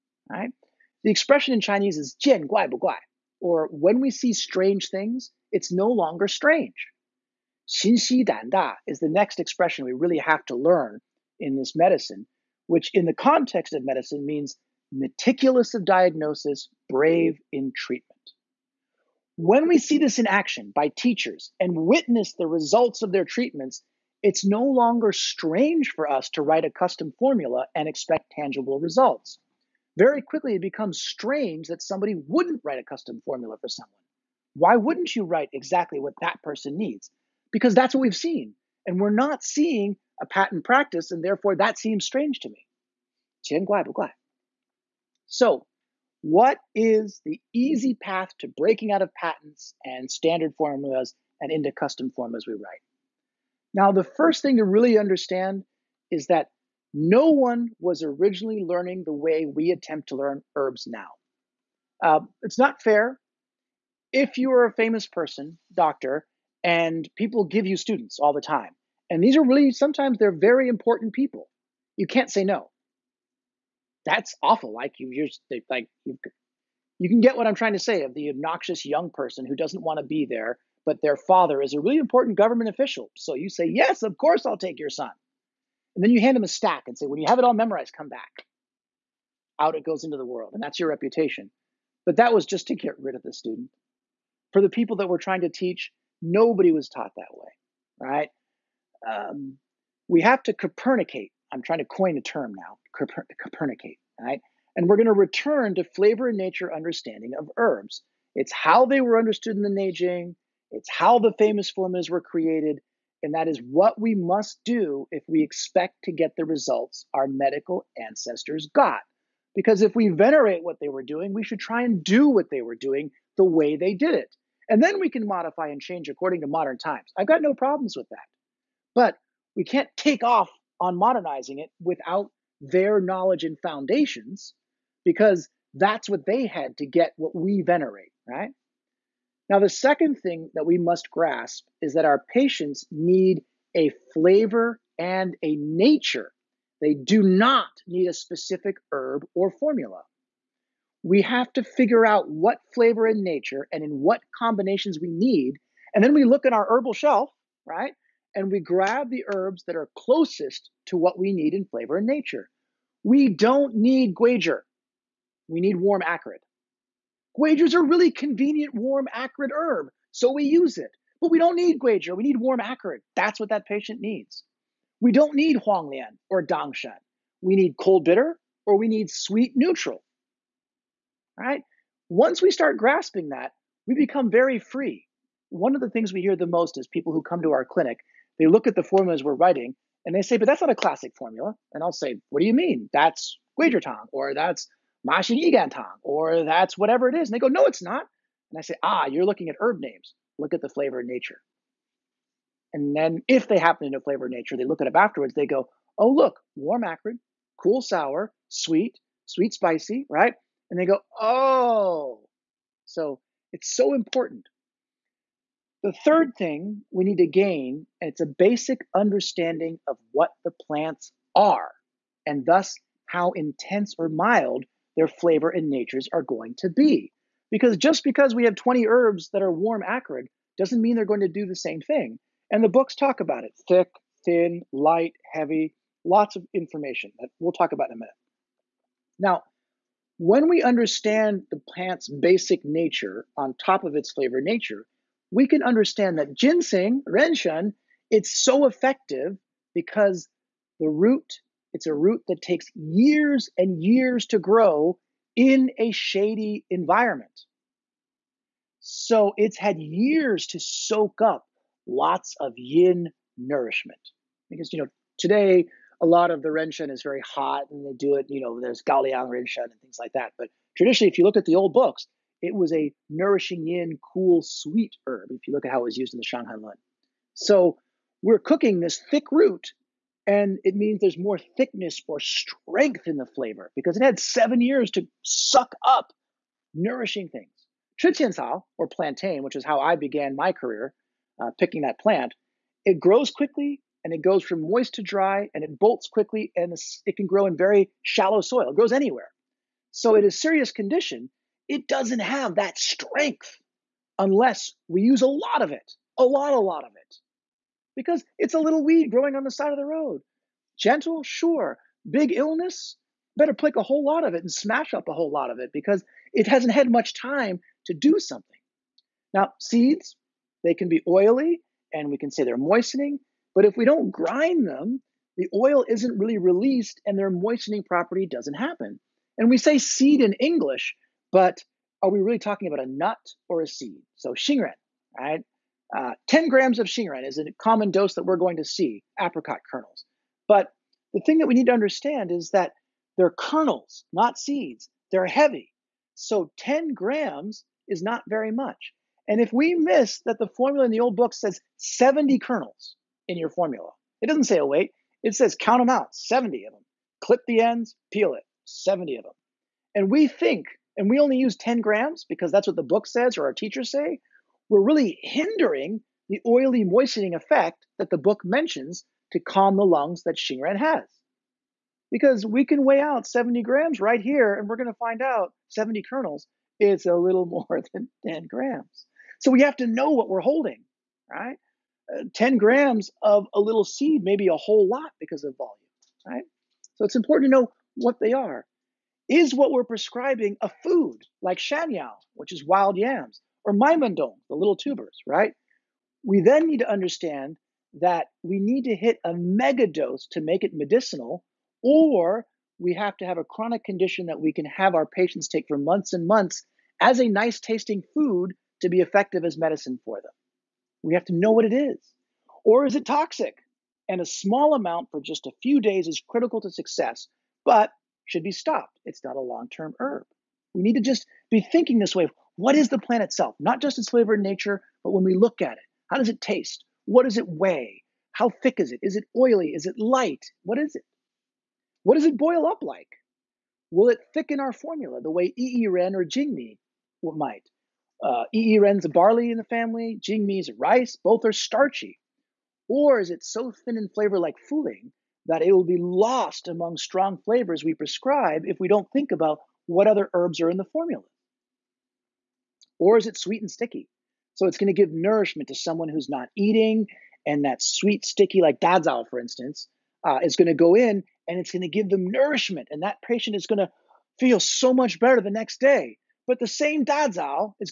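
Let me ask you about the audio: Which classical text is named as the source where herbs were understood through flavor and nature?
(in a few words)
Neijing.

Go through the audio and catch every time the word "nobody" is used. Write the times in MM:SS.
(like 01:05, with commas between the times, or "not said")
01:36.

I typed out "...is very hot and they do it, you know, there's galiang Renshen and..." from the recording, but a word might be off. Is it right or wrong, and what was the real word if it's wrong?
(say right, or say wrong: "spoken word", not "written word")
right.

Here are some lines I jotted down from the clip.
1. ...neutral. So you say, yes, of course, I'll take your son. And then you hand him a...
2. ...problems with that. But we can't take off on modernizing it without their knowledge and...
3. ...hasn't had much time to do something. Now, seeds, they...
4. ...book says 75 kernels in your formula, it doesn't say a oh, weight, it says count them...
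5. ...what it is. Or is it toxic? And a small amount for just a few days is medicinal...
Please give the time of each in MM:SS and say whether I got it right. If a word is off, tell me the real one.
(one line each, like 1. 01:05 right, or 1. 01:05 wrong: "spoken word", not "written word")
1. 01:22 wrong: "official", not "neutral"
2. 02:07 right
3. 05:16 right
4. 05:51 wrong: "70", not "75"
5. 06:51 wrong: "critical", not "medicinal".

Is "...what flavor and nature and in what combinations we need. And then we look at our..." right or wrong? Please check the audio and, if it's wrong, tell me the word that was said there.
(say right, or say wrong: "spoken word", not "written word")
right.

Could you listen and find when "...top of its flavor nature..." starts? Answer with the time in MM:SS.
04:03.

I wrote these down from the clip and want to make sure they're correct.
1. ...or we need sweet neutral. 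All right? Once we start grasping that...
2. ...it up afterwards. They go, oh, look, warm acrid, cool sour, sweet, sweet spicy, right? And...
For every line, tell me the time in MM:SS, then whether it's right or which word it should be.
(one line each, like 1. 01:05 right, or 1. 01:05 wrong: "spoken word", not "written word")
1. 02:58 right
2. 03:24 right.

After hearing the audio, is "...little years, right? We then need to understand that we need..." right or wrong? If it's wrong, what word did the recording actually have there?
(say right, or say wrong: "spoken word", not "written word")
wrong: "tubers", not "years".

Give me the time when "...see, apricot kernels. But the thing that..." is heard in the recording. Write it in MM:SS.
05:38.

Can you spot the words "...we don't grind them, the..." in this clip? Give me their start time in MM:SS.
05:23.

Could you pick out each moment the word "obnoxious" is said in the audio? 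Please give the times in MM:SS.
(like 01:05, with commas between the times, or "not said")
01:18.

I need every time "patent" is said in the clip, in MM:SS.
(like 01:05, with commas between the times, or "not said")
00:40, 00:49.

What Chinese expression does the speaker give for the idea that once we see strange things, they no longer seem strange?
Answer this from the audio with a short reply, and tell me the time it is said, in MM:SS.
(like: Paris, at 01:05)
jian guai bu guai, at 00:02.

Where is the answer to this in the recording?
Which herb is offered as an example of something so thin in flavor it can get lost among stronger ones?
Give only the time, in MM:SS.
07:24.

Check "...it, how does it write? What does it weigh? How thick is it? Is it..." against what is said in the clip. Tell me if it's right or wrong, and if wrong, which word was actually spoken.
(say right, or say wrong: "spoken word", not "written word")
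wrong: "taste", not "write".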